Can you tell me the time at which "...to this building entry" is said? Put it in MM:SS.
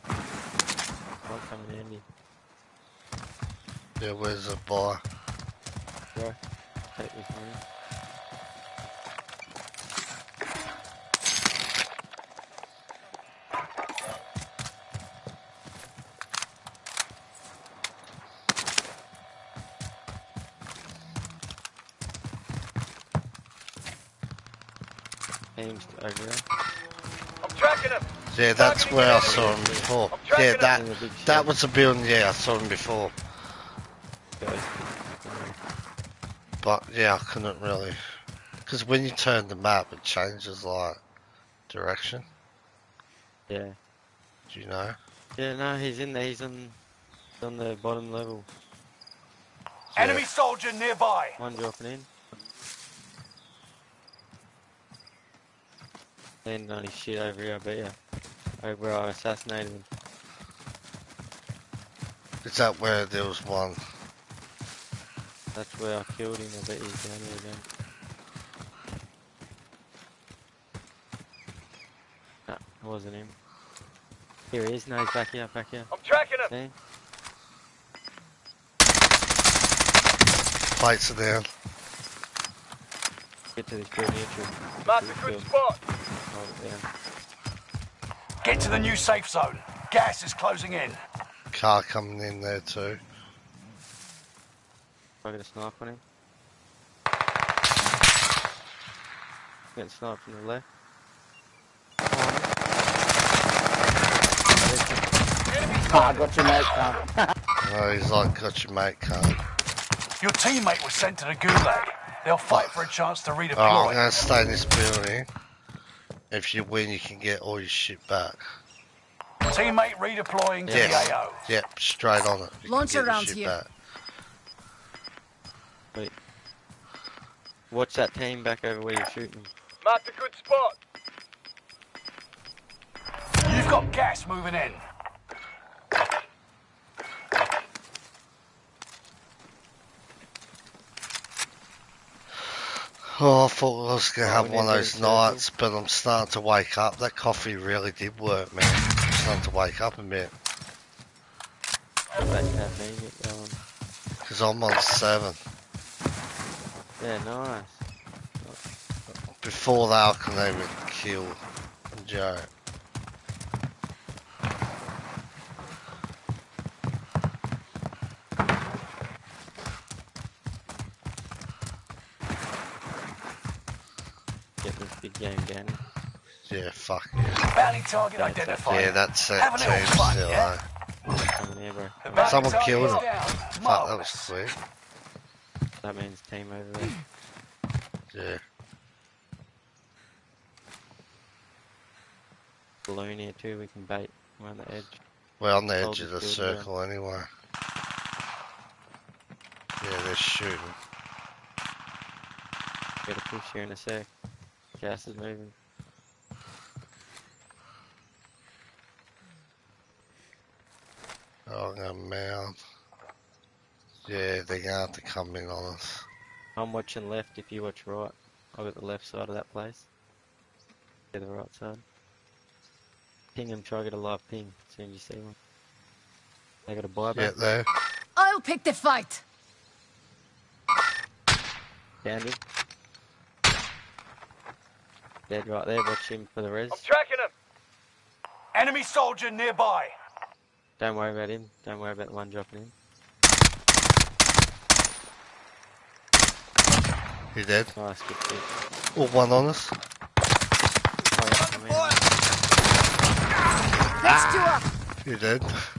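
01:23.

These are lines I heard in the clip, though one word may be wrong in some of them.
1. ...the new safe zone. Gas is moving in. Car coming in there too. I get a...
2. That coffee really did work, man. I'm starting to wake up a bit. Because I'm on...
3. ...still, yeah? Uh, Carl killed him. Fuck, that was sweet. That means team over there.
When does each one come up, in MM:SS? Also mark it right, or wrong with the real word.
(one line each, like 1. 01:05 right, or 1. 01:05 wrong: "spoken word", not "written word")
1. 01:28 wrong: "closing", not "moving"
2. 02:26 right
3. 02:59 wrong: "Someone", not "Carl".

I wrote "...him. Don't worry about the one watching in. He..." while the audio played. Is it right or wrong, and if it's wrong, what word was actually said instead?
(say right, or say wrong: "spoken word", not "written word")
wrong: "dropping", not "watching".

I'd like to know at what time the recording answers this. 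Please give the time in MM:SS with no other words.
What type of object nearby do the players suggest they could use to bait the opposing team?
03:12.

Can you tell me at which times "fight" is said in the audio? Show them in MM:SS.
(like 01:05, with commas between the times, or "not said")
01:52, 03:48.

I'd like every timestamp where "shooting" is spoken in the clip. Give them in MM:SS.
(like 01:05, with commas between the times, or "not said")
02:09, 03:20.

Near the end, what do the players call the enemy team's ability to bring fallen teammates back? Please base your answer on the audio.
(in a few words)
Buyback.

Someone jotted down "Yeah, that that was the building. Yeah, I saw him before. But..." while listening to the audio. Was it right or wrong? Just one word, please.
right.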